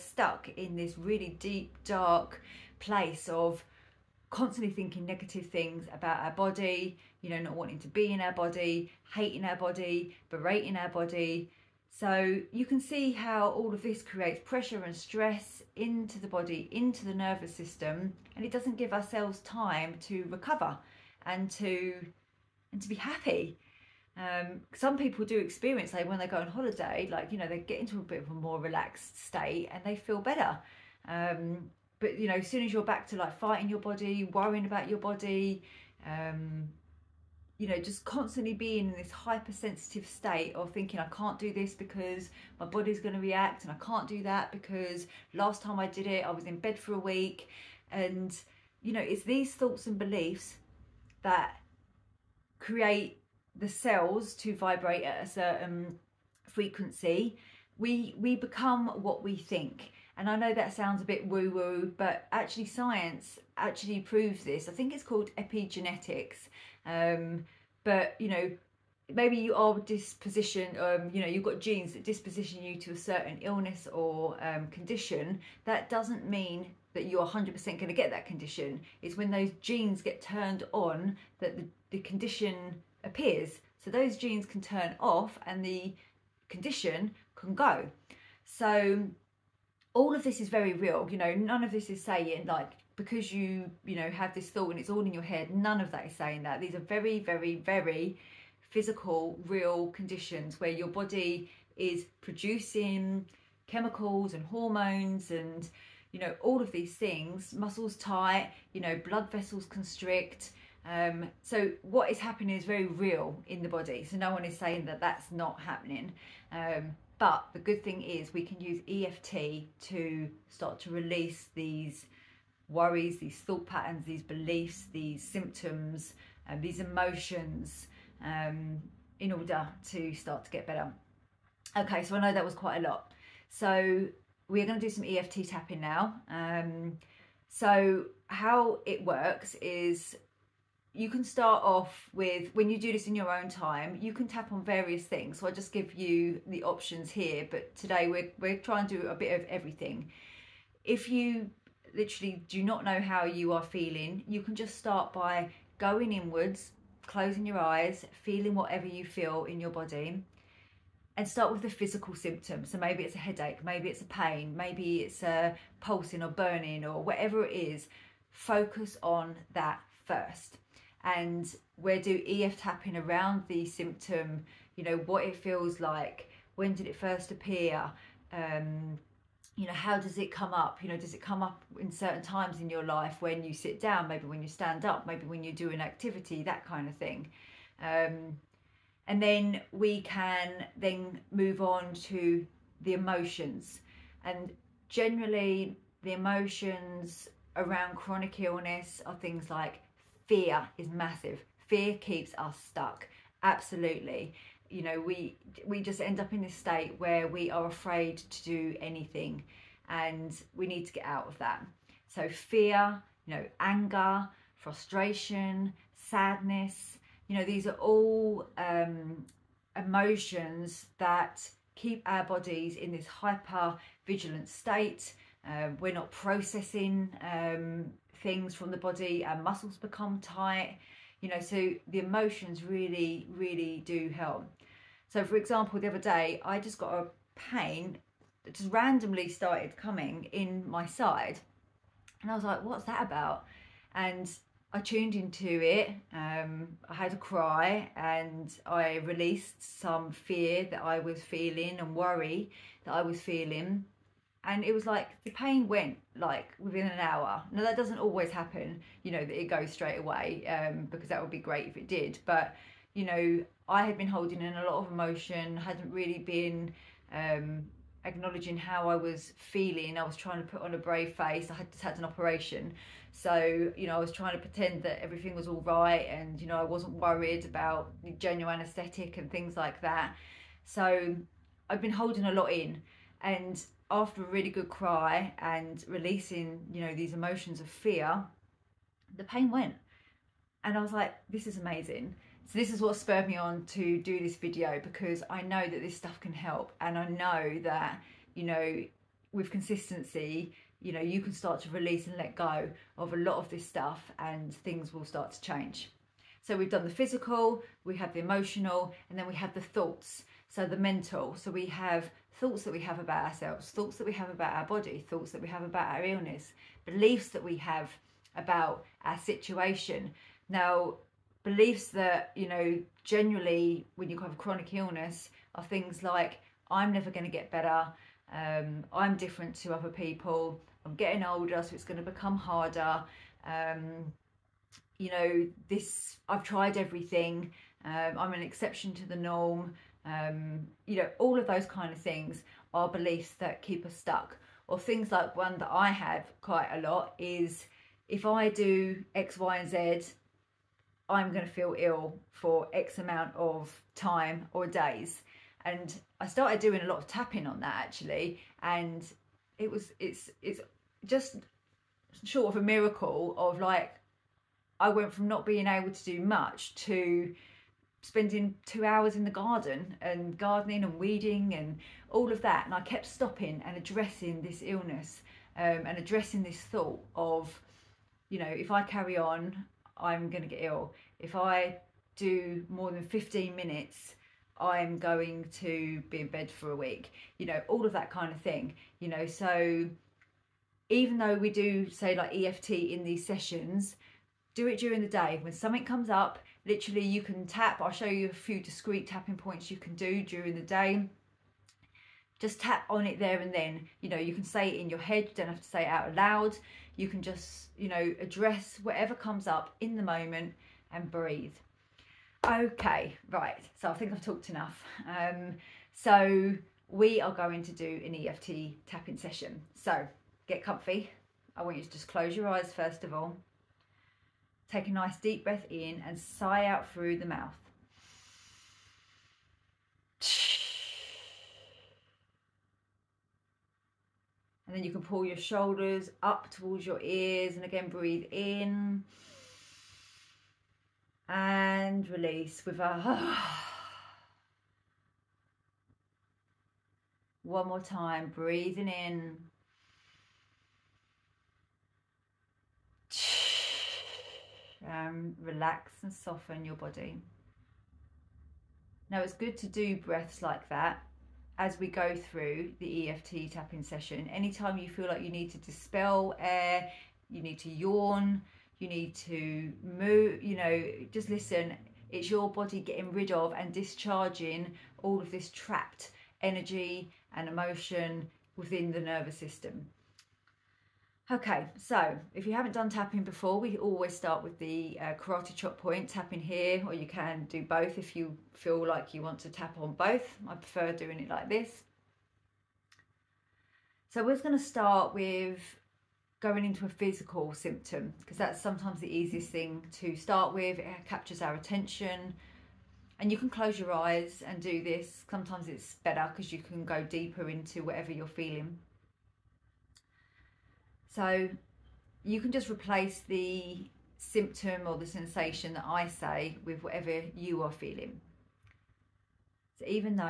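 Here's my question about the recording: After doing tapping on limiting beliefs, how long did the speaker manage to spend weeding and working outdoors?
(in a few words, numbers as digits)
Two hours.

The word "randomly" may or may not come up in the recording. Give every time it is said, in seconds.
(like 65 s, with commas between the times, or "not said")
238 s.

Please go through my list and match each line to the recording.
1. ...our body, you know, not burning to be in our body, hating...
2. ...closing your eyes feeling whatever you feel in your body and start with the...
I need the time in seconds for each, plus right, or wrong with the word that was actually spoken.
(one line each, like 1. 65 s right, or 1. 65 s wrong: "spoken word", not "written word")
1. 6 s wrong: "wanting", not "burning"
2. 157 s right.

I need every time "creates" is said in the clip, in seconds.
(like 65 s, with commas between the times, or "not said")
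14 s, 52 s.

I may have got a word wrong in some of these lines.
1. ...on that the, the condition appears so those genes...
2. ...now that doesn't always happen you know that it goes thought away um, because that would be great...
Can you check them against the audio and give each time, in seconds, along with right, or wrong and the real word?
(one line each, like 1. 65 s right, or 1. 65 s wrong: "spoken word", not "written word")
1. 80 s right
2. 257 s wrong: "straight", not "thought".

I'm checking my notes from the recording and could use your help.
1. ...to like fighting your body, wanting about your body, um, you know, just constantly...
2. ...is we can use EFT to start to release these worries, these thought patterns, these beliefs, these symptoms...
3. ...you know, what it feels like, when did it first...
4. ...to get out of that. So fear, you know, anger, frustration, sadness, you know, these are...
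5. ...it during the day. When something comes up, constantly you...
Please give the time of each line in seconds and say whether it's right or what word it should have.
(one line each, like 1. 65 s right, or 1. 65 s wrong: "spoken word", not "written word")
1. 33 s wrong: "worrying", not "wanting"
2. 118 s right
3. 174 s right
4. 210 s right
5. 394 s wrong: "literally", not "constantly".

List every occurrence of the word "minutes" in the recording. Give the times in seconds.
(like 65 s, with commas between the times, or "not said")
383 s.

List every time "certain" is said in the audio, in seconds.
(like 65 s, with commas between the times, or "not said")
55 s, 72 s, 181 s.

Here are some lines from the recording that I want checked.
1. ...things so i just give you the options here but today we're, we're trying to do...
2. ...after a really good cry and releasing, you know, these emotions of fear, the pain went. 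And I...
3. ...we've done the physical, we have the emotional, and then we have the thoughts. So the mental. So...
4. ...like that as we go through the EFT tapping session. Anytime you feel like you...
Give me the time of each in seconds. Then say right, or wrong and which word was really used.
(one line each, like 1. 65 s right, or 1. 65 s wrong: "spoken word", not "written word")
1. 145 s right
2. 283 s right
3. 306 s right
4. 460 s right.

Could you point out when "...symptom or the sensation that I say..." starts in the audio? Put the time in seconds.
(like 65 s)
514 s.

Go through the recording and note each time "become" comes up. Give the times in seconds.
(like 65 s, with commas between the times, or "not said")
58 s, 229 s, 332 s.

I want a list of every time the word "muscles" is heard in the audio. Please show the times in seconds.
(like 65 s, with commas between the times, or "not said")
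107 s, 229 s.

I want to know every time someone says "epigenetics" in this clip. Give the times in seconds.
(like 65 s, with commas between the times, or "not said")
65 s.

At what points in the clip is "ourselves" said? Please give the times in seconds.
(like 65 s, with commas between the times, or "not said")
18 s, 313 s.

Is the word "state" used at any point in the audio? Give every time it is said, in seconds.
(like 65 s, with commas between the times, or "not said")
29 s, 40 s, 206 s, 224 s.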